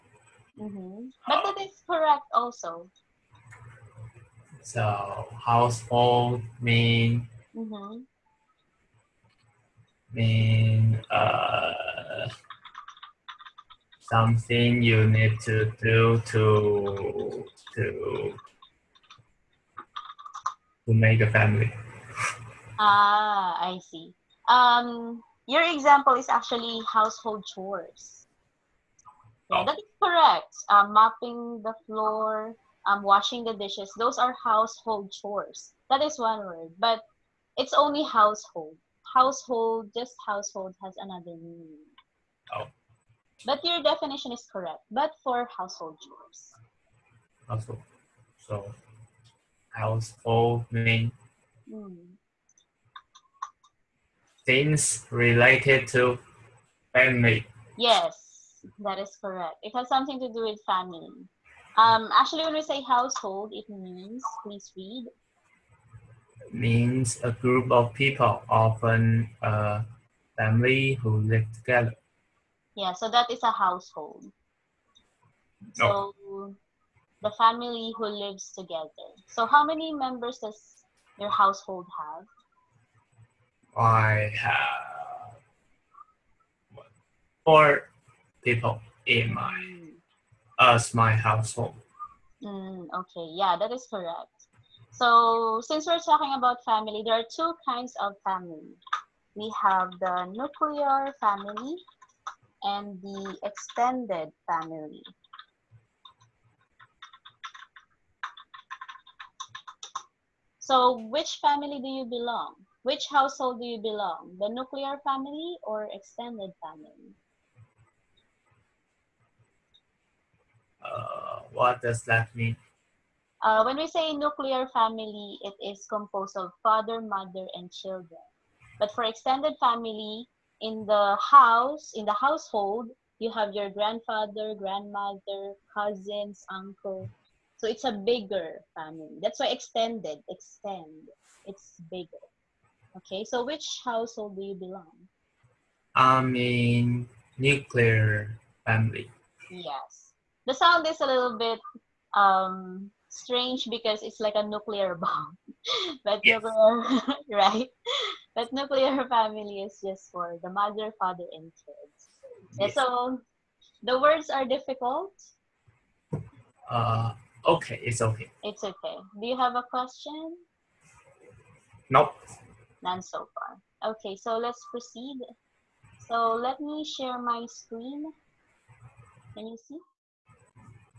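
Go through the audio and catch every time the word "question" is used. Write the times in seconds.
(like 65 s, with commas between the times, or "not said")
169 s.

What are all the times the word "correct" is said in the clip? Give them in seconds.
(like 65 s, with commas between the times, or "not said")
1 s, 30 s, 44 s, 59 s, 93 s.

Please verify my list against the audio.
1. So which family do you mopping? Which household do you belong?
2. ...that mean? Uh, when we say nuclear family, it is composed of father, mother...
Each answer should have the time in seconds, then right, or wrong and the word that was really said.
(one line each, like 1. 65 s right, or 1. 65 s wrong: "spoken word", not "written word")
1. 110 s wrong: "belong", not "mopping"
2. 122 s right.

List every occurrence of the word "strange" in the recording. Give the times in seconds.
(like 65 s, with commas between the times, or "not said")
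153 s.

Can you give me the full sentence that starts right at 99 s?
We have the nuclear family and the extended family.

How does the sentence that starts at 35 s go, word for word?
That is one word, but it's only household.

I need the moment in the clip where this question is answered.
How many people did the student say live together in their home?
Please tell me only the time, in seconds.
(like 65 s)
87 s.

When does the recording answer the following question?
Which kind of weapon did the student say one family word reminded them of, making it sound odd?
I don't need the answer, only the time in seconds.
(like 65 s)
154 s.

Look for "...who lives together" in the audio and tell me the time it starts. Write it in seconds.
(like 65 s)
77 s.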